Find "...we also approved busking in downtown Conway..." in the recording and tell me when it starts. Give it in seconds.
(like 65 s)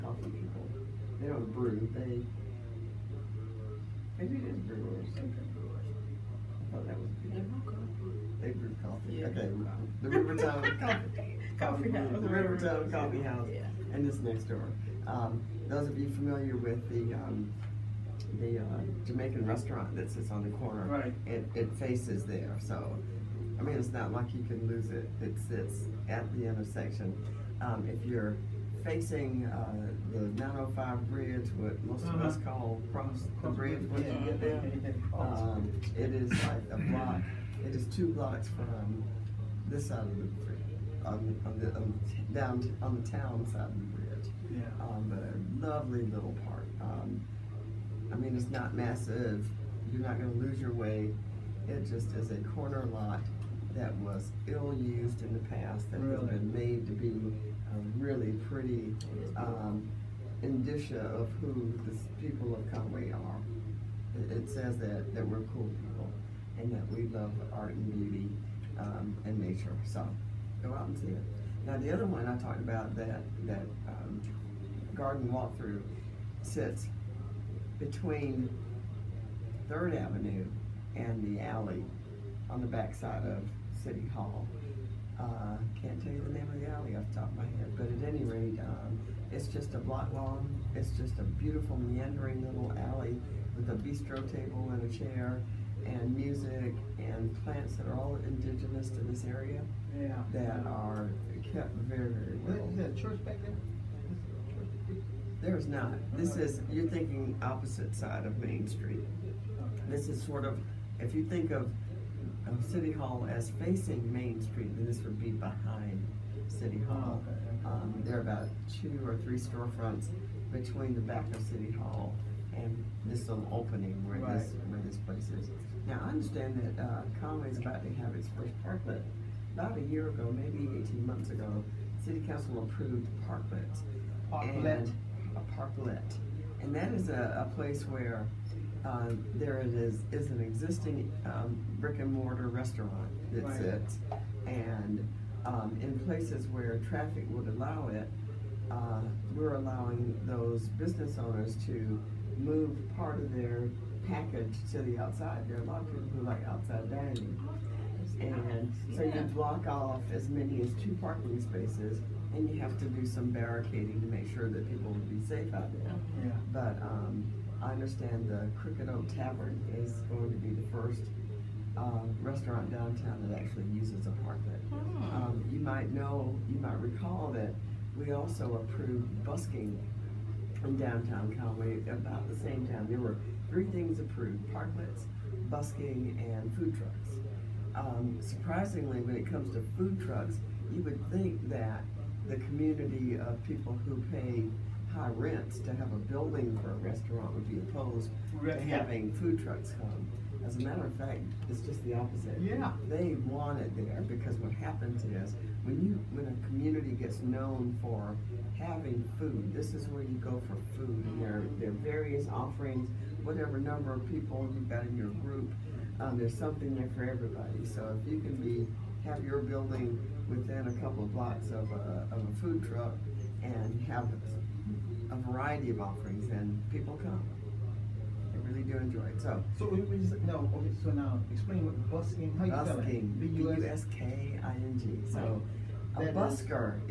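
177 s.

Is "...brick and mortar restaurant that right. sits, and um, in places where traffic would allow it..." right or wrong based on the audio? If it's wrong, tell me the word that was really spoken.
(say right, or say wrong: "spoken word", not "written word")
right.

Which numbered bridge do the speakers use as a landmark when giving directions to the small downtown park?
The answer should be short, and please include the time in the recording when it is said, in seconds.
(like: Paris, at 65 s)
905 bridge, at 30 s.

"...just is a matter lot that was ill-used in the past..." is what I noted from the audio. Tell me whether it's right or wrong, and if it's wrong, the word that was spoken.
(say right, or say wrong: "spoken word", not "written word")
wrong: "corner", not "matter".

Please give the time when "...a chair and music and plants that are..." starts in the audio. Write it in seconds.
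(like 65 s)
94 s.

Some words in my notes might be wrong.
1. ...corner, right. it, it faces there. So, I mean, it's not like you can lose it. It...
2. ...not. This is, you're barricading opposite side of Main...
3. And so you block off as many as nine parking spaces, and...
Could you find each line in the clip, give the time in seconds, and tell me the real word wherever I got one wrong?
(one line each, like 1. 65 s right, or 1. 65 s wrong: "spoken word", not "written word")
1. 20 s right
2. 105 s wrong: "thinking", not "barricading"
3. 158 s wrong: "two", not "nine".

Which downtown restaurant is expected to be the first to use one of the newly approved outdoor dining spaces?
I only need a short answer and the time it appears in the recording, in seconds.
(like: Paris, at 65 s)
Crooked Oak Tavern, at 168 s.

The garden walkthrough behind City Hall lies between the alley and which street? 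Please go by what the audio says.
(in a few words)
3rd Avenue.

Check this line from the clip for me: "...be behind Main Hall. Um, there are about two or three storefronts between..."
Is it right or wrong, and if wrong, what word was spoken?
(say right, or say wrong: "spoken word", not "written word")
wrong: "City", not "Main".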